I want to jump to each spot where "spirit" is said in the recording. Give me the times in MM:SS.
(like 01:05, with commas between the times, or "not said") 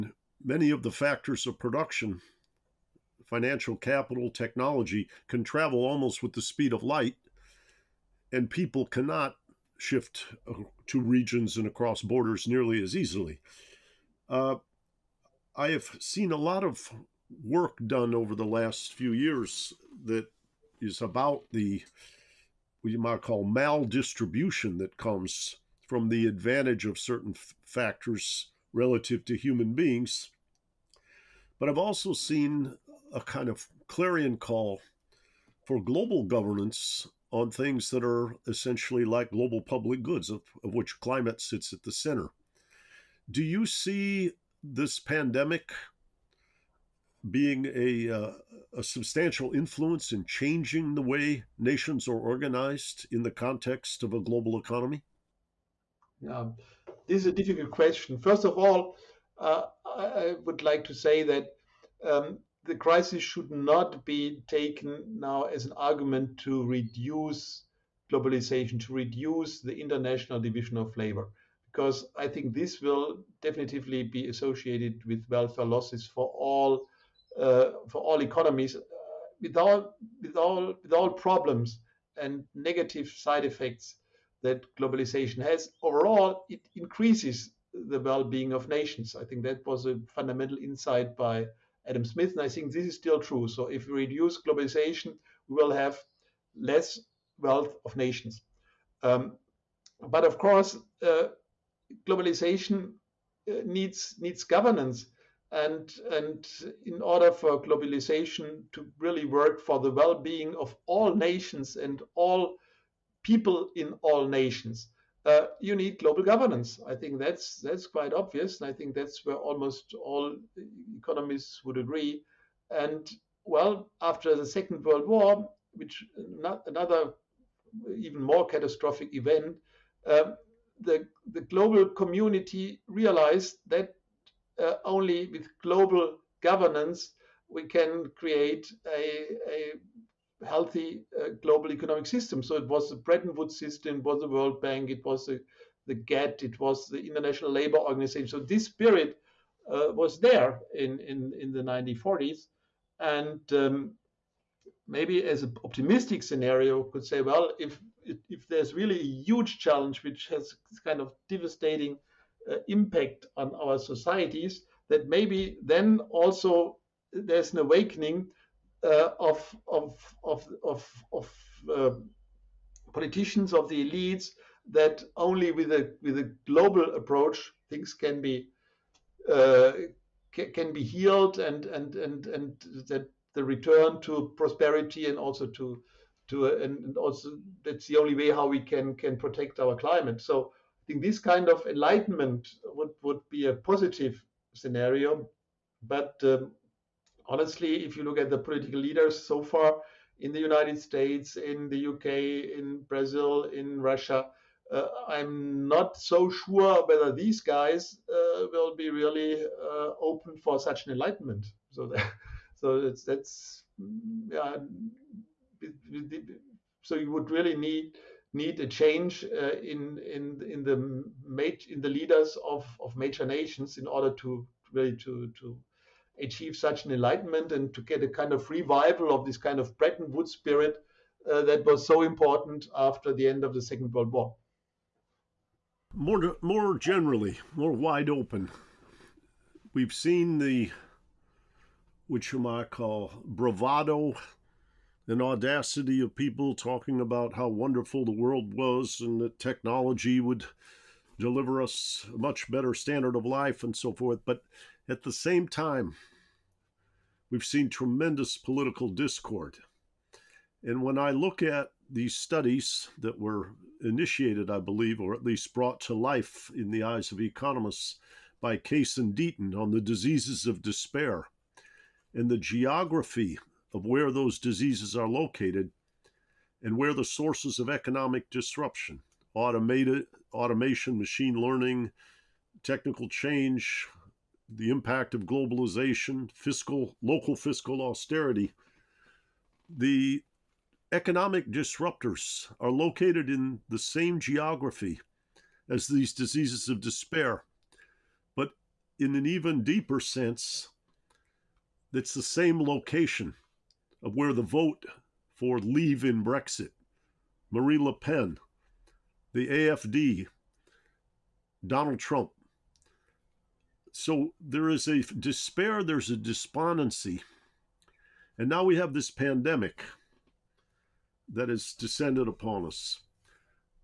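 02:28, 03:50.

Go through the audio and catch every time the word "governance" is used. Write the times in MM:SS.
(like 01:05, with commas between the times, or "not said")
00:36, 01:44, 01:56, 02:16.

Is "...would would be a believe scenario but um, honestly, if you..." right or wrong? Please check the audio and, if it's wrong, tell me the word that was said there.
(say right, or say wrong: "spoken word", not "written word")
wrong: "positive", not "believe".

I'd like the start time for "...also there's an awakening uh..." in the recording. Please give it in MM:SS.
02:46.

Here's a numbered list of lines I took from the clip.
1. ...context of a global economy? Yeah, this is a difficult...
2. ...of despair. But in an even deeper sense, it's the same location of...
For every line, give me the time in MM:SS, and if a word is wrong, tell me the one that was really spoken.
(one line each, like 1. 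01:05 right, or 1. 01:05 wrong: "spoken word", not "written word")
1. 00:53 right
2. 04:56 right.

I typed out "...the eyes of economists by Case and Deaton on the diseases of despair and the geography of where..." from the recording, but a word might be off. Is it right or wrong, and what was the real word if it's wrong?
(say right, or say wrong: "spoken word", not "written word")
right.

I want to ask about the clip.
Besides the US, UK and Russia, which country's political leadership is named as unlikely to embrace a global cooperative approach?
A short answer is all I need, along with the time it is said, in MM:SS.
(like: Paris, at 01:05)
Brazil, at 03:22.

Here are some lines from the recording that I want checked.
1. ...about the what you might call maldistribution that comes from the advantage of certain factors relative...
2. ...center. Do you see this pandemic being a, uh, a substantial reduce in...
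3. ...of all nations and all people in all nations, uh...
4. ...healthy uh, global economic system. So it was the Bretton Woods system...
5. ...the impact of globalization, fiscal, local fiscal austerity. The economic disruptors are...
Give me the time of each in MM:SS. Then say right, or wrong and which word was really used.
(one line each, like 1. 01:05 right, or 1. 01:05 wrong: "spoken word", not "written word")
1. 00:21 right
2. 00:41 wrong: "influence", not "reduce"
3. 01:50 right
4. 02:20 right
5. 04:44 right.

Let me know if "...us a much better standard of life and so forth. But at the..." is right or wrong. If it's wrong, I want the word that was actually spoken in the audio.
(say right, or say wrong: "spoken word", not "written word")
right.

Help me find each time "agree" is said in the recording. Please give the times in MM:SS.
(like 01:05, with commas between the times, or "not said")
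02:01.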